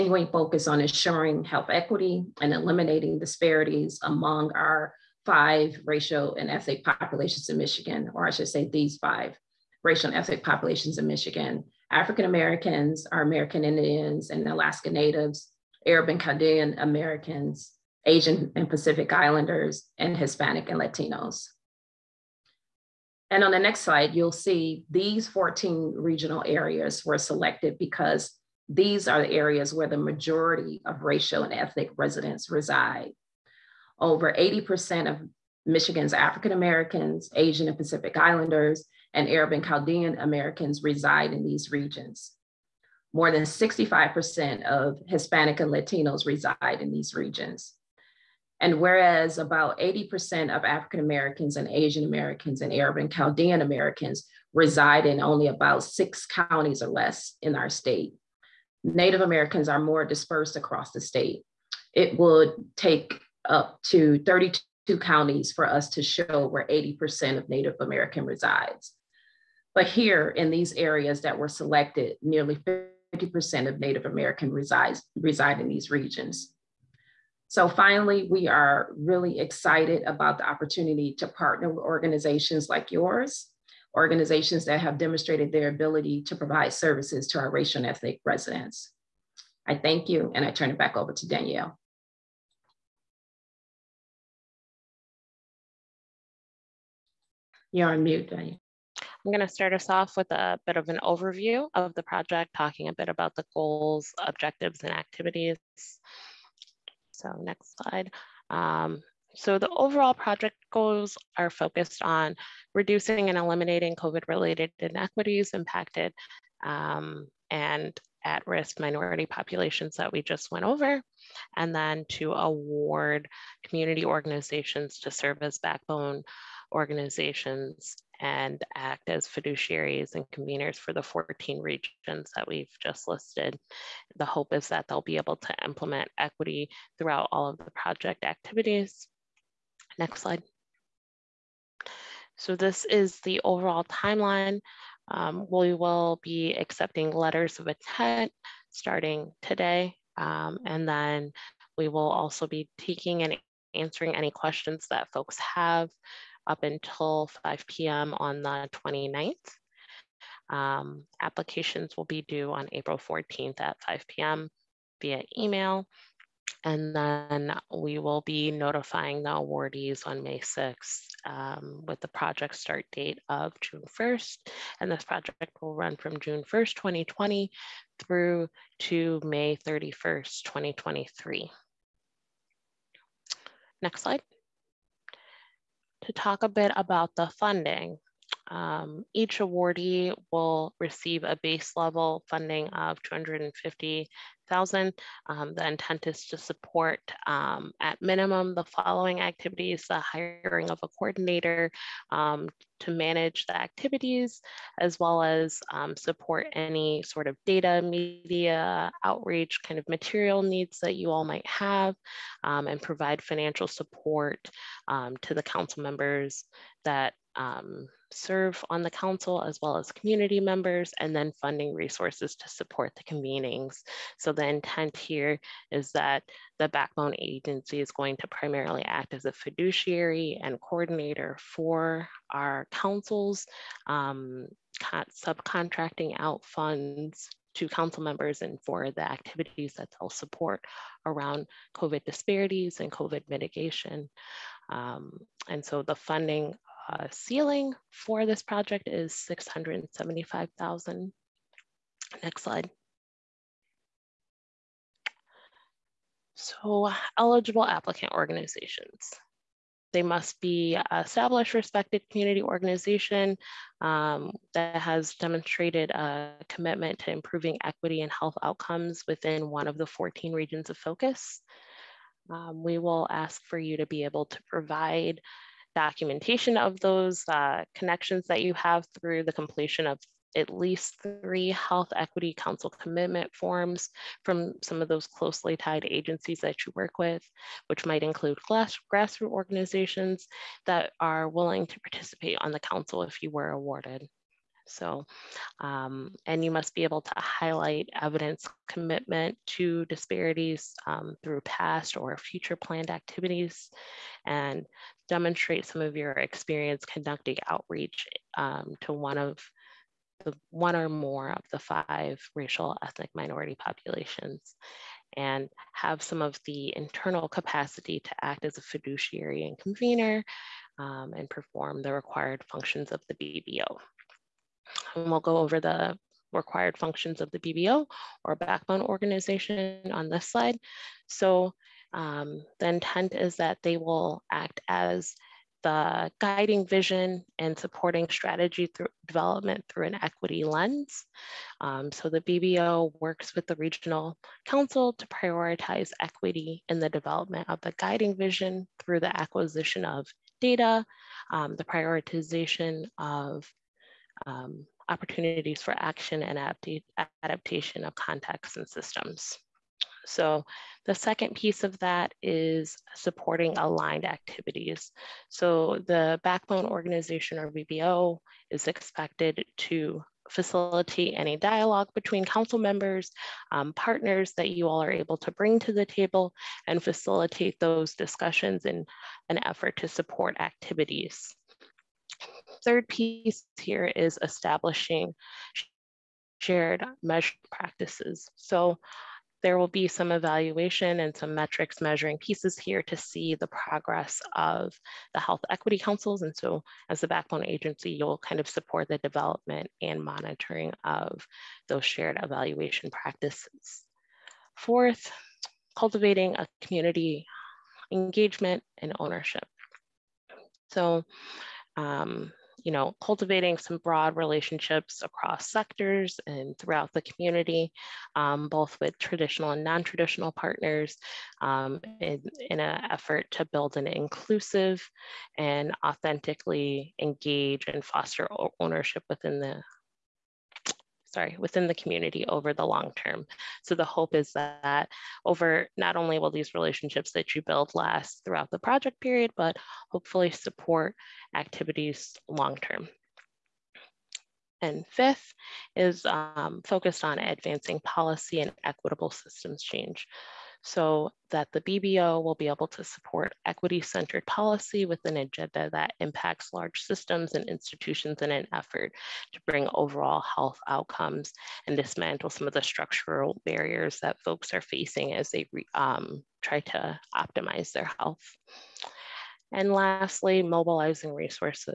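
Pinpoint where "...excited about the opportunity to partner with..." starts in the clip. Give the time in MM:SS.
01:19.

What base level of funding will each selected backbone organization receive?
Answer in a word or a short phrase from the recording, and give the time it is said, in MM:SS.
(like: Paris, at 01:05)
$250,000, at 03:13.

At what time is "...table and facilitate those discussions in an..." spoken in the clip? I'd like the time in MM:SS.
06:15.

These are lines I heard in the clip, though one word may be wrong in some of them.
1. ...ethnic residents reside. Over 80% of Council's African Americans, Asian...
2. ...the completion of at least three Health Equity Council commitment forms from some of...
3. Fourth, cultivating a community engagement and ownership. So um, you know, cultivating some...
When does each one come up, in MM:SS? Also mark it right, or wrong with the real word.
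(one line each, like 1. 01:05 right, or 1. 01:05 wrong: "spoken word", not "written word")
1. 00:31 wrong: "Michigan", not "Council"
2. 04:39 right
3. 06:44 right.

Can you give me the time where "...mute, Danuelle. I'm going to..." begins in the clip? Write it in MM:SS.
01:38.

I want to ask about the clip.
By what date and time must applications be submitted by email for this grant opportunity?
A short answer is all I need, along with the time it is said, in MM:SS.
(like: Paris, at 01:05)
April 14th at 5 p.m., at 02:42.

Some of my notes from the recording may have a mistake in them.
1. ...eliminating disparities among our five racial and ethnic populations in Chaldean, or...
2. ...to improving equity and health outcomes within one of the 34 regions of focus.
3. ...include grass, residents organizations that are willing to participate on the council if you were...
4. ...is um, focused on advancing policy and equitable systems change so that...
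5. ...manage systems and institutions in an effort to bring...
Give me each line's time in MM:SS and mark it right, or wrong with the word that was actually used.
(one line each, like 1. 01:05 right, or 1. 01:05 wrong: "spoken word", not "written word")
1. 00:02 wrong: "Michigan", not "Chaldean"
2. 04:27 wrong: "14", not "34"
3. 04:48 wrong: "grassroots", not "residents"
4. 07:25 right
5. 07:36 wrong: "large", not "manage".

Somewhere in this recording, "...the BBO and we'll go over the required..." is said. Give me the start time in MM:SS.
05:23.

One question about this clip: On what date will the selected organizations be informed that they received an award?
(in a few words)
May 6th.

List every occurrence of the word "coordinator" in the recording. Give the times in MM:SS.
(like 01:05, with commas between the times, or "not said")
03:20, 03:50.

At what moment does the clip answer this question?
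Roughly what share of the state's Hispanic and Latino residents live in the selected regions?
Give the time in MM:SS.
00:43.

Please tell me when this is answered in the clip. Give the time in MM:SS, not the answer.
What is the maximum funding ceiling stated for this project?
04:09.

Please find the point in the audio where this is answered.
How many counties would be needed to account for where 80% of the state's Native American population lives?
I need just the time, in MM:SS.
01:04.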